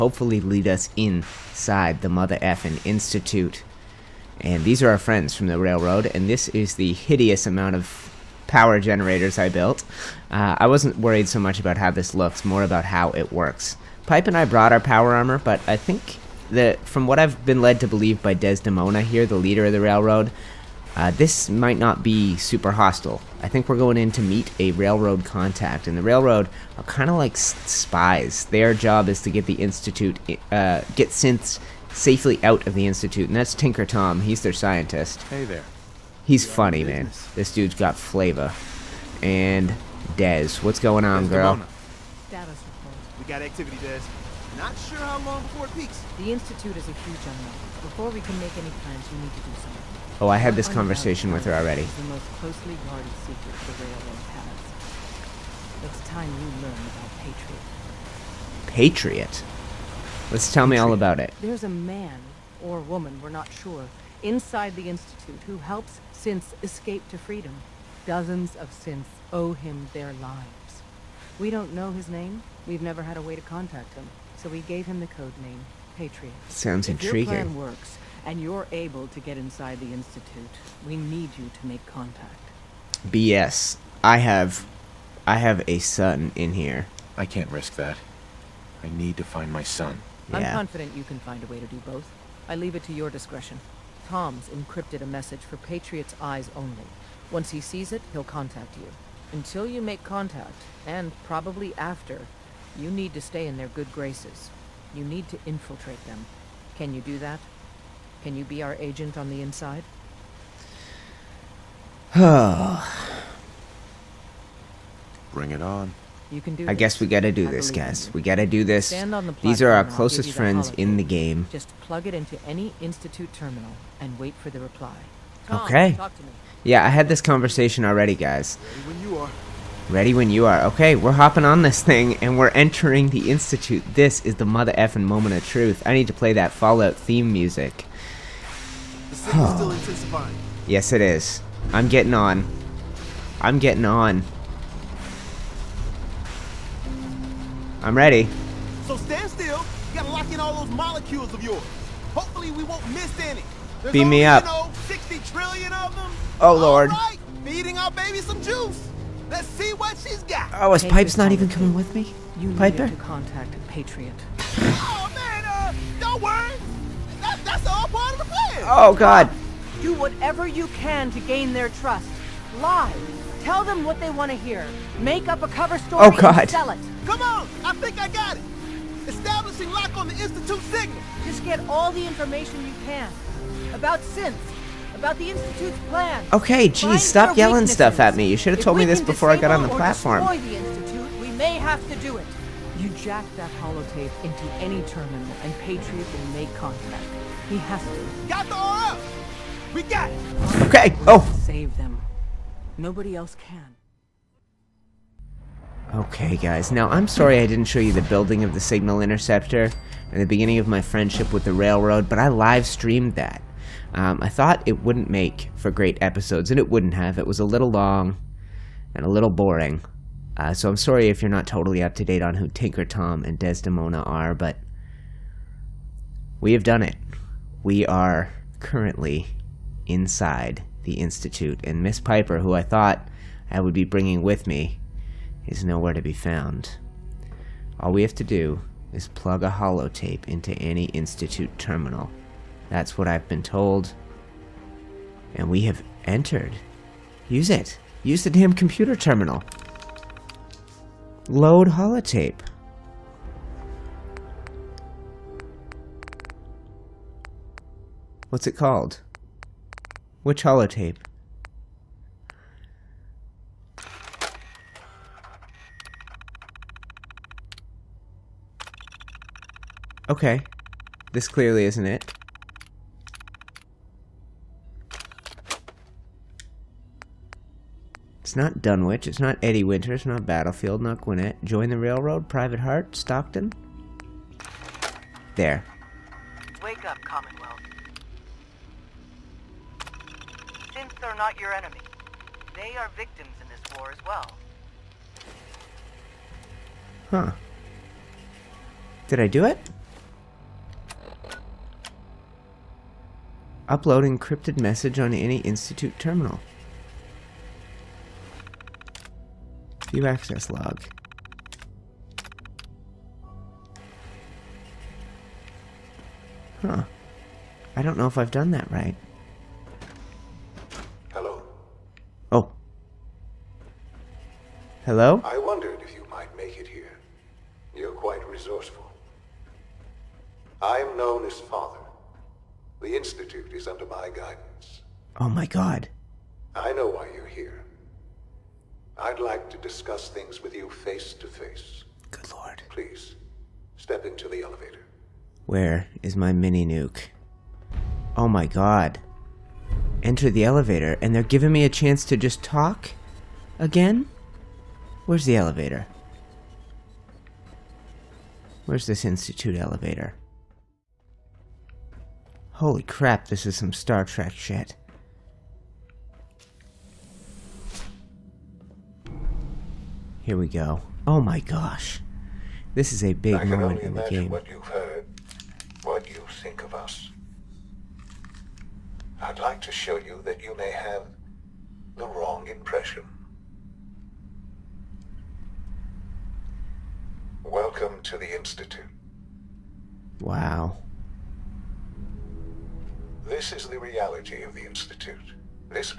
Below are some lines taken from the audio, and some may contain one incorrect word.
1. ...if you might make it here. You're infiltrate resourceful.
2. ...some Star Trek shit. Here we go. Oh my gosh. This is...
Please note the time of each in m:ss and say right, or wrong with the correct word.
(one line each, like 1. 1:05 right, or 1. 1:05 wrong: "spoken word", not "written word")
1. 5:25 wrong: "quite", not "infiltrate"
2. 6:03 right.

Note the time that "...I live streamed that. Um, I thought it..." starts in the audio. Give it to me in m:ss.
3:32.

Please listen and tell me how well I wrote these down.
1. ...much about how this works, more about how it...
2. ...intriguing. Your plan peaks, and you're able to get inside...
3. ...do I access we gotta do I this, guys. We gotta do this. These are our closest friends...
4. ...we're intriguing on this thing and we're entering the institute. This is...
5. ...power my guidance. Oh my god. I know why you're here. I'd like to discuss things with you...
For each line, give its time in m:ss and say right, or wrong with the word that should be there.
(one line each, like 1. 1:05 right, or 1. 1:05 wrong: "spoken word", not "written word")
1. 0:11 wrong: "looks", not "works"
2. 1:17 wrong: "works", not "peaks"
3. 1:56 wrong: "guess", not "access"
4. 2:10 wrong: "hopping", not "intriguing"
5. 5:33 wrong: "under", not "power".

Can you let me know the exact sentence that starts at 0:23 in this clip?
I think we're going in to meet a railroad contact, and the railroad are kind of like spies.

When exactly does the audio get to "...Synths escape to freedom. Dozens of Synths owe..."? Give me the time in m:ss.
1:06.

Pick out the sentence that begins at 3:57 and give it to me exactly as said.
All we have to do is plug a holotape into any Institute terminal.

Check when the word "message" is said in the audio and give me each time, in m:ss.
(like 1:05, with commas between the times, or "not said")
1:35, 5:04.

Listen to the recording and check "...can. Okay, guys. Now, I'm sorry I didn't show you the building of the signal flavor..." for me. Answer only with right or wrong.
wrong.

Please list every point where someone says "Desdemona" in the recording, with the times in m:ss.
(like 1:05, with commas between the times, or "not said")
0:18, 3:43.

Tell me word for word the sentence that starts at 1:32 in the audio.
I leave it to your discretion.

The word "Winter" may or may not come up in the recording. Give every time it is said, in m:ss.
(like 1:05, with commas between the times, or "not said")
4:39.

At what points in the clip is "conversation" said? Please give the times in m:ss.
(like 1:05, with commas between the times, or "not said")
0:50, 2:07.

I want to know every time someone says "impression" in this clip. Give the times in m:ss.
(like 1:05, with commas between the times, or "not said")
6:22.